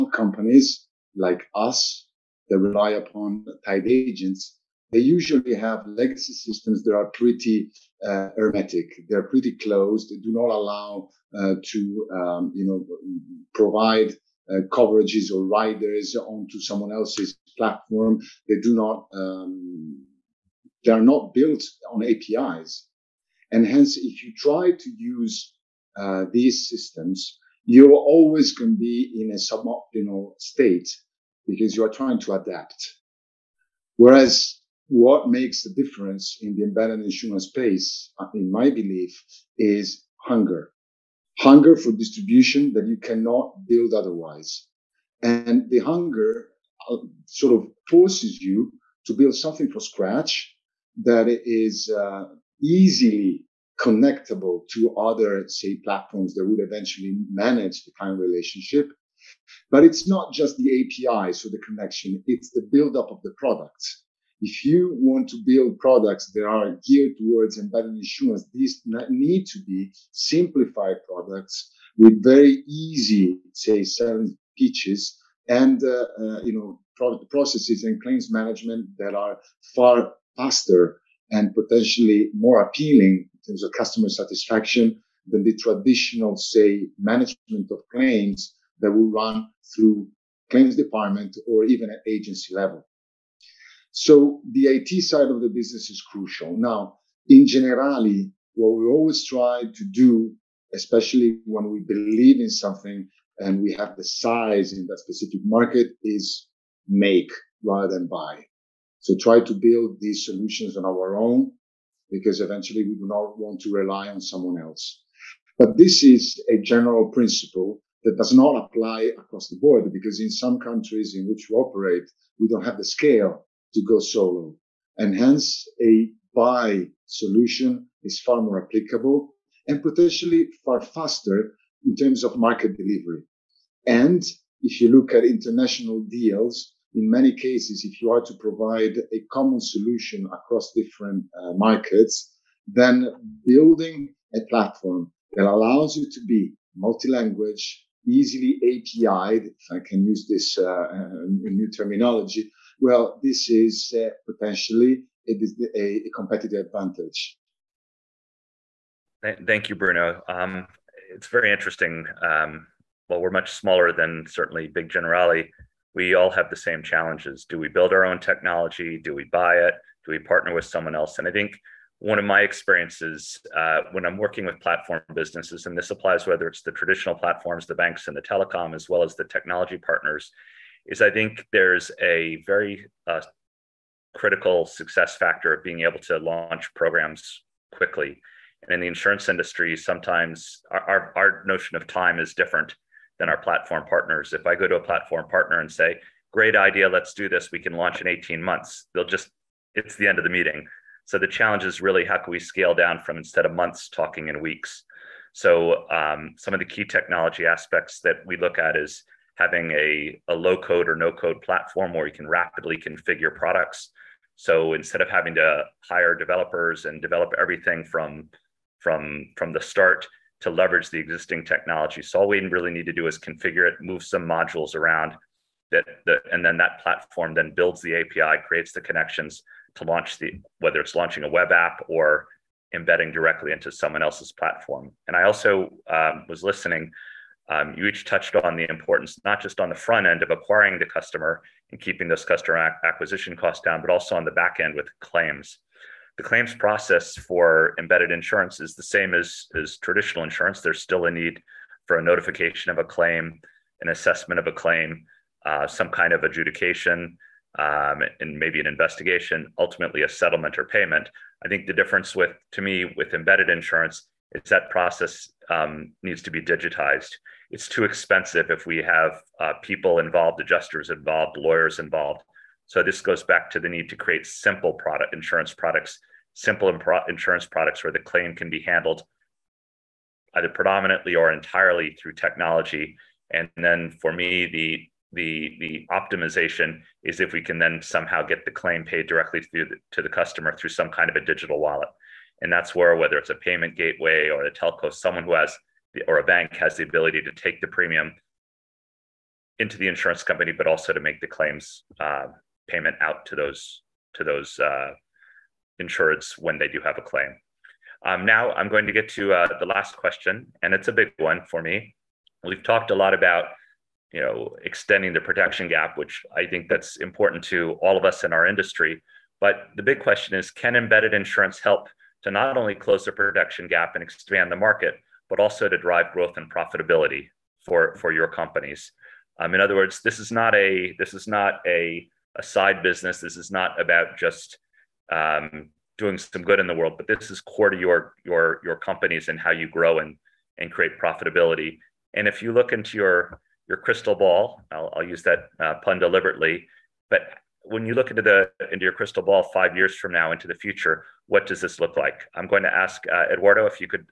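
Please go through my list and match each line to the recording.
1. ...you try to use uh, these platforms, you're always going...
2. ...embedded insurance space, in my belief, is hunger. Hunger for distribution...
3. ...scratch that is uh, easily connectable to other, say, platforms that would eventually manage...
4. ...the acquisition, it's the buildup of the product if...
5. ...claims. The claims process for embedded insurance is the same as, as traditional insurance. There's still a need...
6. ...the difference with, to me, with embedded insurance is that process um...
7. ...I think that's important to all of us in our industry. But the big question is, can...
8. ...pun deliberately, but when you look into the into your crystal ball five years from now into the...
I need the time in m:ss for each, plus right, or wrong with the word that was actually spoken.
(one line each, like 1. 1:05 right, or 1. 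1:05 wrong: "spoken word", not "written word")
1. 0:24 wrong: "systems", not "platforms"
2. 0:36 right
3. 0:49 right
4. 1:01 wrong: "connection", not "acquisition"
5. 4:05 right
6. 4:21 right
7. 5:16 right
8. 5:45 right.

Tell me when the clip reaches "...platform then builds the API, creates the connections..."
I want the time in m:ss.
3:46.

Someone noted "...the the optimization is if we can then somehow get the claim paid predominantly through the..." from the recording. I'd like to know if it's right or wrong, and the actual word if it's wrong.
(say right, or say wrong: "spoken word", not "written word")
wrong: "directly", not "predominantly".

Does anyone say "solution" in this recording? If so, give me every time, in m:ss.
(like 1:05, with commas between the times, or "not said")
1:50, 2:07, 2:19.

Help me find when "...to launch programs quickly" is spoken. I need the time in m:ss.
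3:06.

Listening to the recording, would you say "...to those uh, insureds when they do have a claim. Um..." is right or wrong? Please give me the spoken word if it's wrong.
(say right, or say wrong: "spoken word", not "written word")
right.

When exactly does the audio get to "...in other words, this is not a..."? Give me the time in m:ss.
5:29.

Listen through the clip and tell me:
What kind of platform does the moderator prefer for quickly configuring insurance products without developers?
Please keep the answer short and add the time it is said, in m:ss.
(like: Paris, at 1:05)
Low code or no code, at 3:30.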